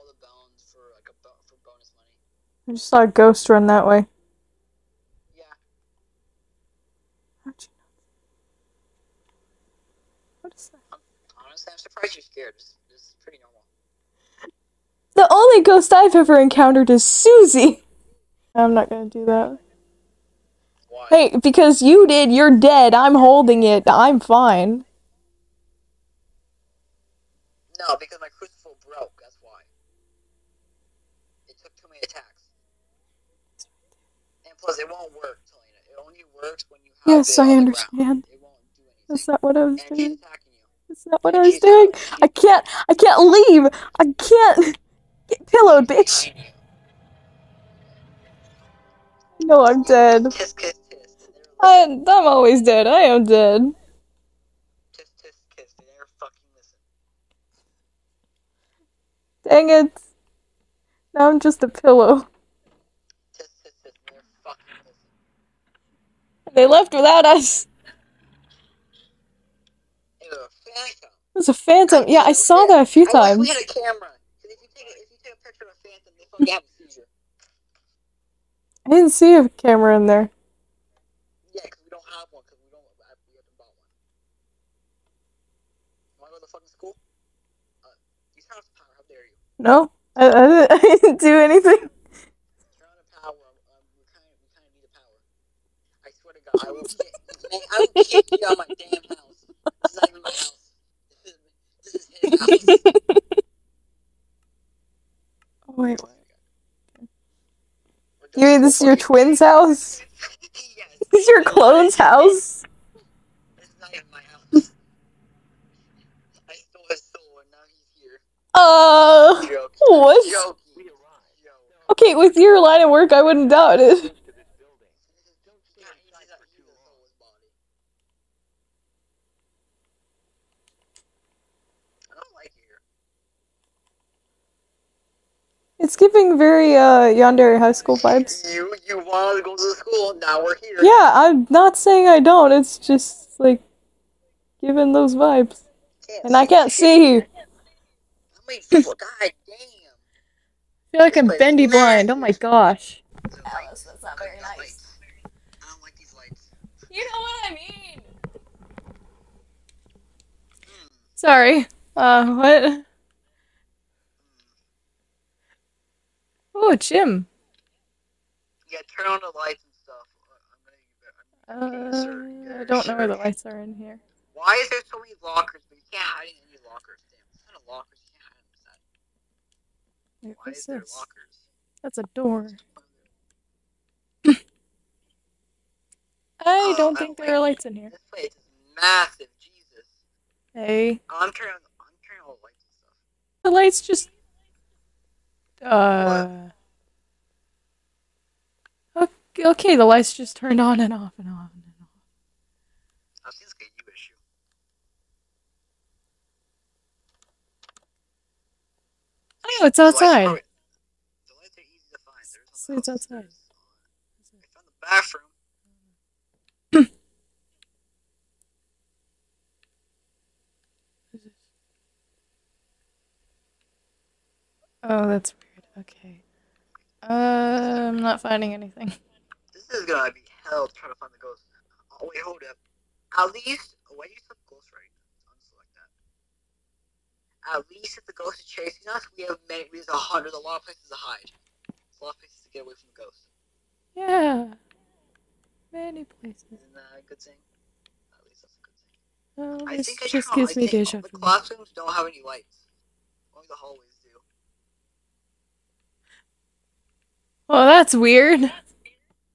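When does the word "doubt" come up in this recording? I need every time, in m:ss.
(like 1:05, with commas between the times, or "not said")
2:03.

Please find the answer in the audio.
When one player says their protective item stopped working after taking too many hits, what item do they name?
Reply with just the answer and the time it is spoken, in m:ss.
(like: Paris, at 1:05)
Crucible, at 0:28.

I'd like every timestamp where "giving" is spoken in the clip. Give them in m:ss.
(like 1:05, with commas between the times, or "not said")
2:15, 2:24.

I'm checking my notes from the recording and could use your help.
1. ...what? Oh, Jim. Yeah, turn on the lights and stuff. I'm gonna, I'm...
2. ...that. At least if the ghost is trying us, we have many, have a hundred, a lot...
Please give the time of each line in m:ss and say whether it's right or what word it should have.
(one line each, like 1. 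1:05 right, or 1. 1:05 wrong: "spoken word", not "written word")
1. 2:42 right
2. 3:55 wrong: "chasing", not "trying".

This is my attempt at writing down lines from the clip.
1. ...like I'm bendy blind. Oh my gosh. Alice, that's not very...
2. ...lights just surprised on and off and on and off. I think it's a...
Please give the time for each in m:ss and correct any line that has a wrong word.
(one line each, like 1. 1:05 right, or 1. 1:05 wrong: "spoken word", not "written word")
1. 2:31 right
2. 3:19 wrong: "turned", not "surprised".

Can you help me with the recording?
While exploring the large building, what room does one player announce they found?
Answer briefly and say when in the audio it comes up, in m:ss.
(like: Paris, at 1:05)
The bathroom, at 3:35.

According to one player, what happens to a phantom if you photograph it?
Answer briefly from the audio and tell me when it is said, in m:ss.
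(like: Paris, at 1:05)
They have a seizure, at 1:16.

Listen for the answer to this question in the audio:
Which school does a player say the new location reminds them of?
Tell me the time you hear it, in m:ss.
2:17.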